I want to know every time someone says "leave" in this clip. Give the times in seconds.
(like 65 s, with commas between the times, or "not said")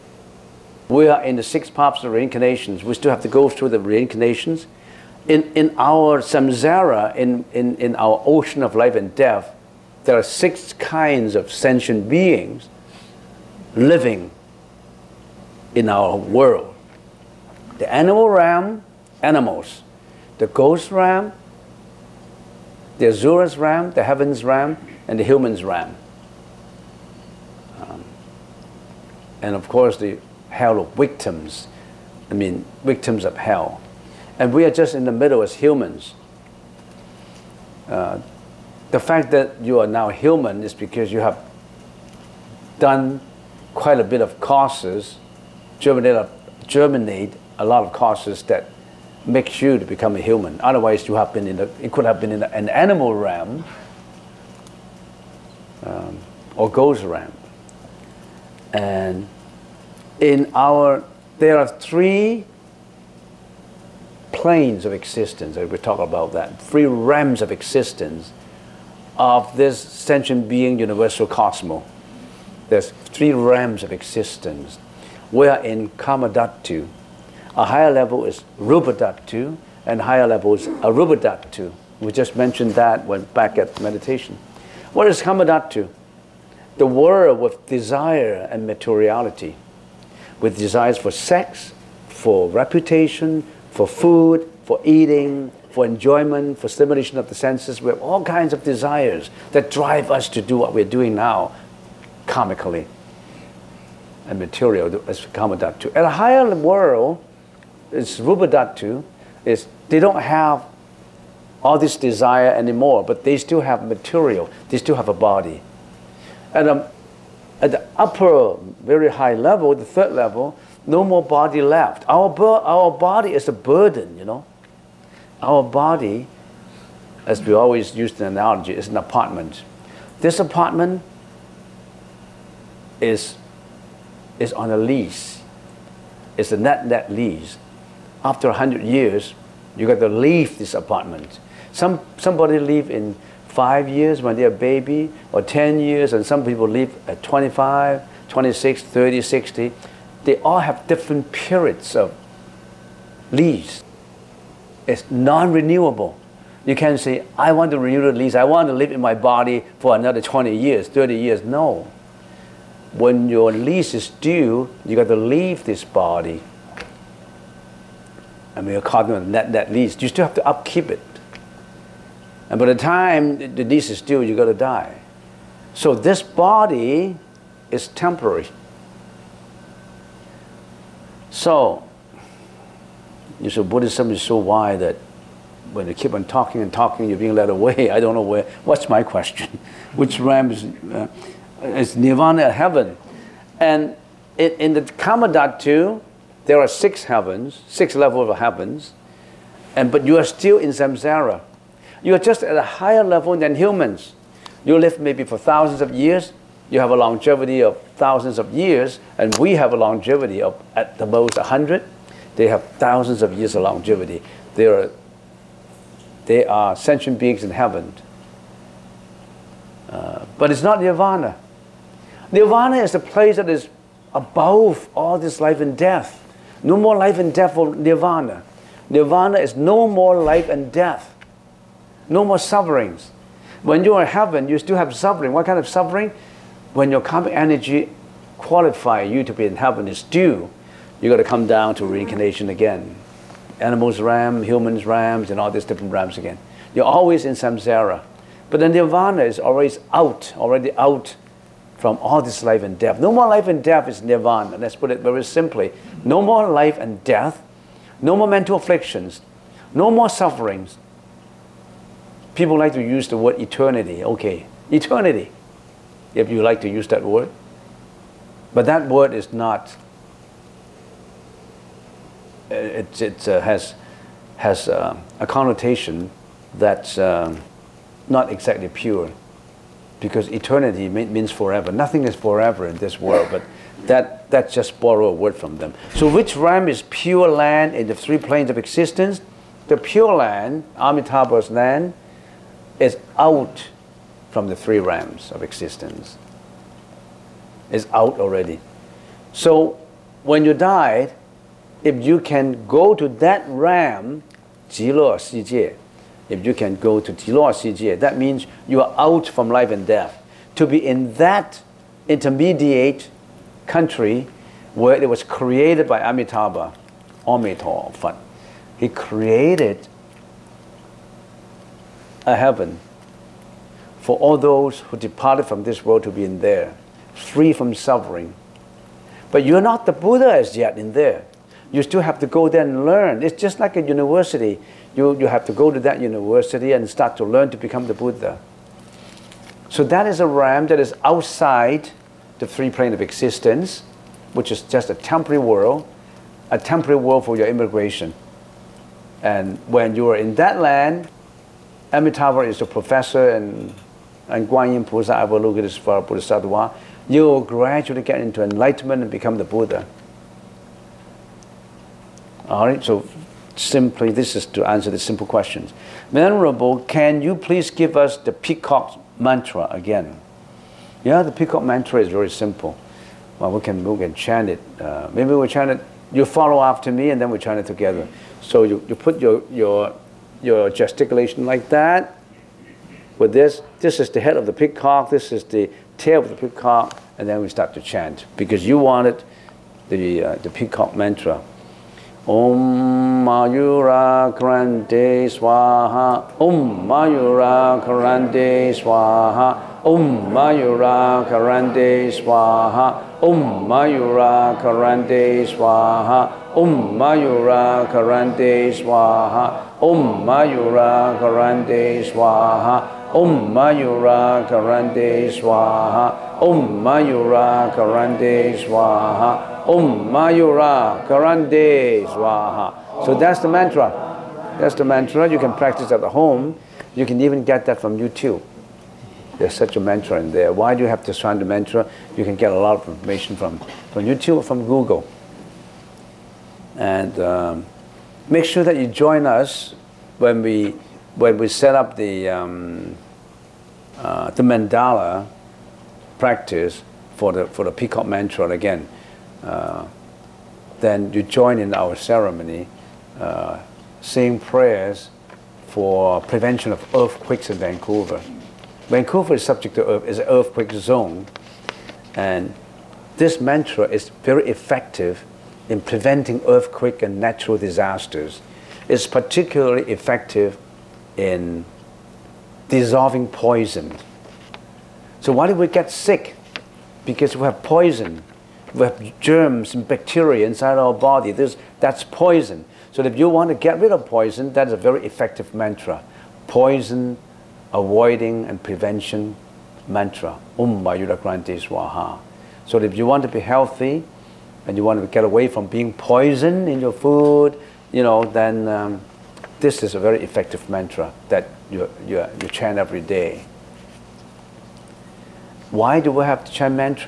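140 s, 165 s.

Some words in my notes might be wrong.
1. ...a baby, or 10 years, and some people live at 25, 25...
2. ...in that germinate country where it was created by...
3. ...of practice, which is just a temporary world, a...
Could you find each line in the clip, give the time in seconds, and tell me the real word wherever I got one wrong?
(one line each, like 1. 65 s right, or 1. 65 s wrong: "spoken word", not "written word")
1. 144 s wrong: "26", not "25"
2. 310 s wrong: "intermediate", not "germinate"
3. 342 s wrong: "existence", not "practice".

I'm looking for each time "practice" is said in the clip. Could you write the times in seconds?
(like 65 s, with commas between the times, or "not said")
425 s, 446 s.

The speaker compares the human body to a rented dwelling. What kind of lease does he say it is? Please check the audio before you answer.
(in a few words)
net-net lease.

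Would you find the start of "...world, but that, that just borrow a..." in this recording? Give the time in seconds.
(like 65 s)
283 s.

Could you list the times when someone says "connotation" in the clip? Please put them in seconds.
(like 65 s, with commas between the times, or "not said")
275 s.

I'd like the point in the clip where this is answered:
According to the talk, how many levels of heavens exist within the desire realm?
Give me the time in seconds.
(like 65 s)
197 s.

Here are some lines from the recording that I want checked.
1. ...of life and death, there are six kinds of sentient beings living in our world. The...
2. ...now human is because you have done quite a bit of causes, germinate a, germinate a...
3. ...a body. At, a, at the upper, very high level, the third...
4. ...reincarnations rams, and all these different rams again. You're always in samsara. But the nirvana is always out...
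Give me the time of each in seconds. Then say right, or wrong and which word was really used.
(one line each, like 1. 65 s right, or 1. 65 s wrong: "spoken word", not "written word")
1. 8 s right
2. 39 s right
3. 115 s right
4. 244 s wrong: "humans", not "reincarnations".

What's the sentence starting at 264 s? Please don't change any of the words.
Okay, eternity, if you like to use that word.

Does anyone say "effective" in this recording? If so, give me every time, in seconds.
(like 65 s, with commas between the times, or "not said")
464 s, 469 s, 485 s, 500 s.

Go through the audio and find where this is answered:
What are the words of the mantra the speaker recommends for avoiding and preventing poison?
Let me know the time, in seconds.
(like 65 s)
490 s.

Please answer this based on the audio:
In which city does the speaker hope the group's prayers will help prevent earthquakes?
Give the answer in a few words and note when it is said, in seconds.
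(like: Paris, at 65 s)
Vancouver, at 456 s.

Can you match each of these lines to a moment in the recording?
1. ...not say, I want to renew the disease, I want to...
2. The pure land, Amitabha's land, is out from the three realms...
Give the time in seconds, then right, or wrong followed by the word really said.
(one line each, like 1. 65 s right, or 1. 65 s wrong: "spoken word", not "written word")
1. 156 s wrong: "lease", not "disease"
2. 289 s right.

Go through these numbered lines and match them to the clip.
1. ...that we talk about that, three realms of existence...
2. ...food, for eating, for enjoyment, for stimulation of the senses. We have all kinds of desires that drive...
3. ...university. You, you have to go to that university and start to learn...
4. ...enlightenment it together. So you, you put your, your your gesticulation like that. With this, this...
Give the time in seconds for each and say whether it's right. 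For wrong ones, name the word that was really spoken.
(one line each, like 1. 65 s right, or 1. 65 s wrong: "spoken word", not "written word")
1. 65 s right
2. 93 s right
3. 333 s right
4. 377 s wrong: "chant", not "enlightenment".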